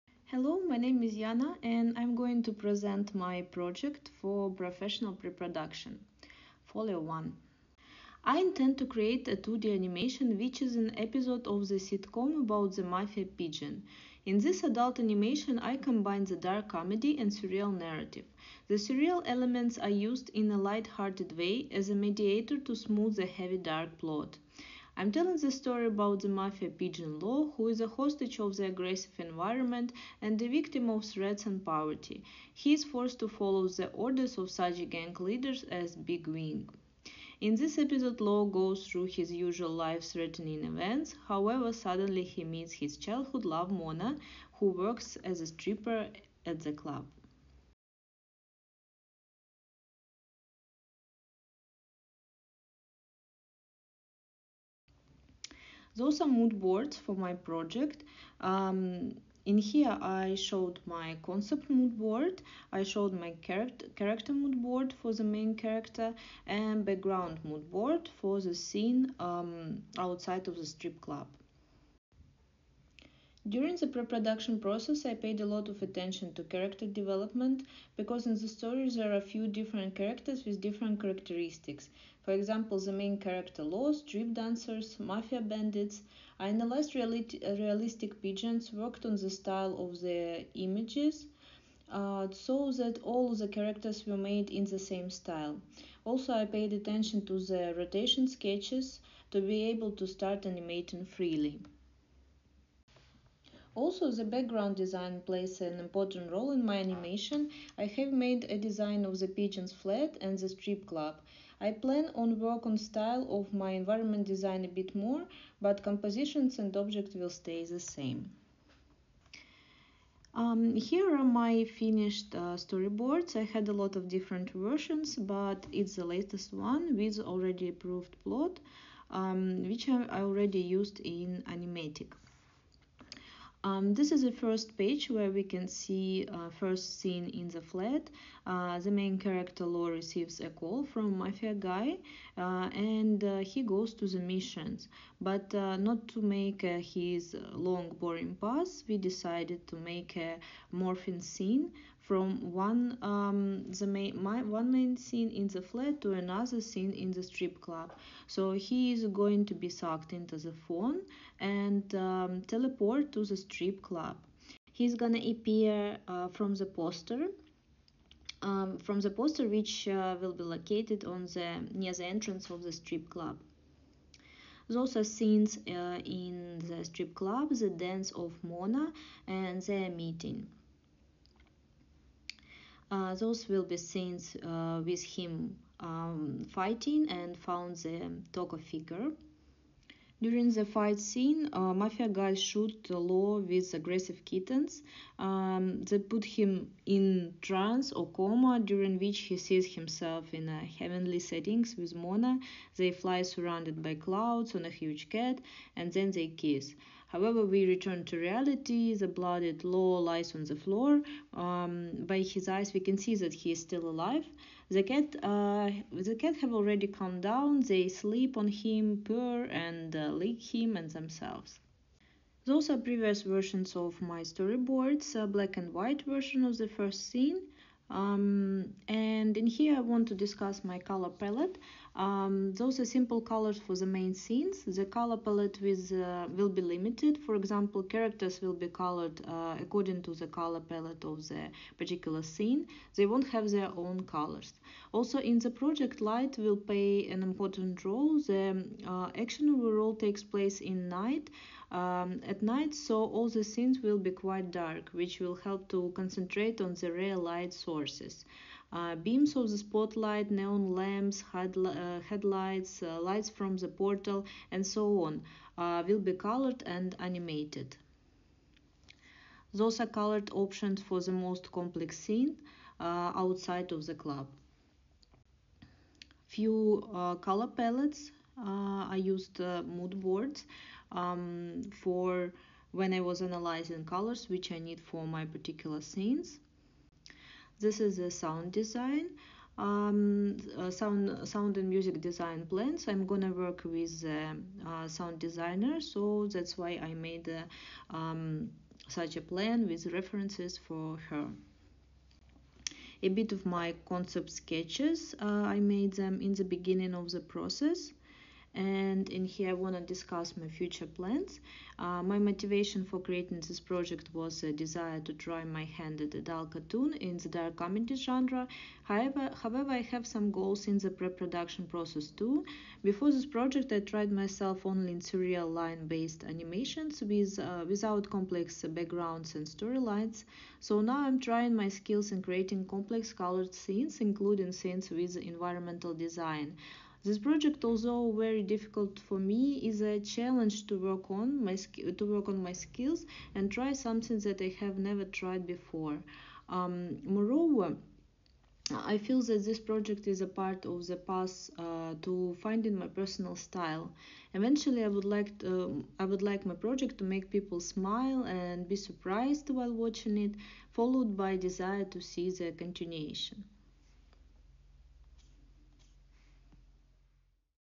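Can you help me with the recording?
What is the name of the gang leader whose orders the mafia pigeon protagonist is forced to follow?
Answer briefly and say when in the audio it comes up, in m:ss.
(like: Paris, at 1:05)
Big Wing, at 0:35.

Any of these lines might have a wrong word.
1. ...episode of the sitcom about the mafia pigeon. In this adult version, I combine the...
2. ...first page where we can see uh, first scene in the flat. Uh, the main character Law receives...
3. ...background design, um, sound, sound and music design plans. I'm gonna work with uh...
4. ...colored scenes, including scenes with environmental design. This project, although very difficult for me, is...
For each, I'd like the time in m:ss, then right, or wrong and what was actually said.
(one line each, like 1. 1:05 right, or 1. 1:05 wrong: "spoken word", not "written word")
1. 0:10 wrong: "animation", not "version"
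2. 2:14 right
3. 4:48 wrong: "sound", not "background"
4. 5:33 right.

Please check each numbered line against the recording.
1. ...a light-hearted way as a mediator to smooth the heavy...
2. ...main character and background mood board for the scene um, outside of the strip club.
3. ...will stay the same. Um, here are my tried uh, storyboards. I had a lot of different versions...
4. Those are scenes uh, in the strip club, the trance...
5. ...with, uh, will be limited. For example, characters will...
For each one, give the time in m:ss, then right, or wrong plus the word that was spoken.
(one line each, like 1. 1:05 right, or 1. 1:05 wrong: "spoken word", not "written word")
1. 0:20 right
2. 1:05 right
3. 1:57 wrong: "finished", not "tried"
4. 2:54 wrong: "dance", not "trance"
5. 3:55 right.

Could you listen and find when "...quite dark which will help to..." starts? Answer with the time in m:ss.
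4:14.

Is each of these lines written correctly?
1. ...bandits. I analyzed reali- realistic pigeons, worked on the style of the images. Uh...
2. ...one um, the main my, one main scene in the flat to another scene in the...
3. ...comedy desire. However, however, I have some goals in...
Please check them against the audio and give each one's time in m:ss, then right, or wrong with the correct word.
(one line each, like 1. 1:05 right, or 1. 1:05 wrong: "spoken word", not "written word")
1. 1:25 right
2. 2:32 right
3. 5:17 wrong: "genre", not "desire".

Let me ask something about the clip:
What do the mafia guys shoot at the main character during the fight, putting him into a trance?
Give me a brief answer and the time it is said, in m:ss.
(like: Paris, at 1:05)
aggressive kittens, at 3:13.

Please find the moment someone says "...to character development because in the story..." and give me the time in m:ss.
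1:16.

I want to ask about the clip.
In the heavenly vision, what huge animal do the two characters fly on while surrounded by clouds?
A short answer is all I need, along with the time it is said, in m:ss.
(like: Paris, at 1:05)
a huge cat, at 3:24.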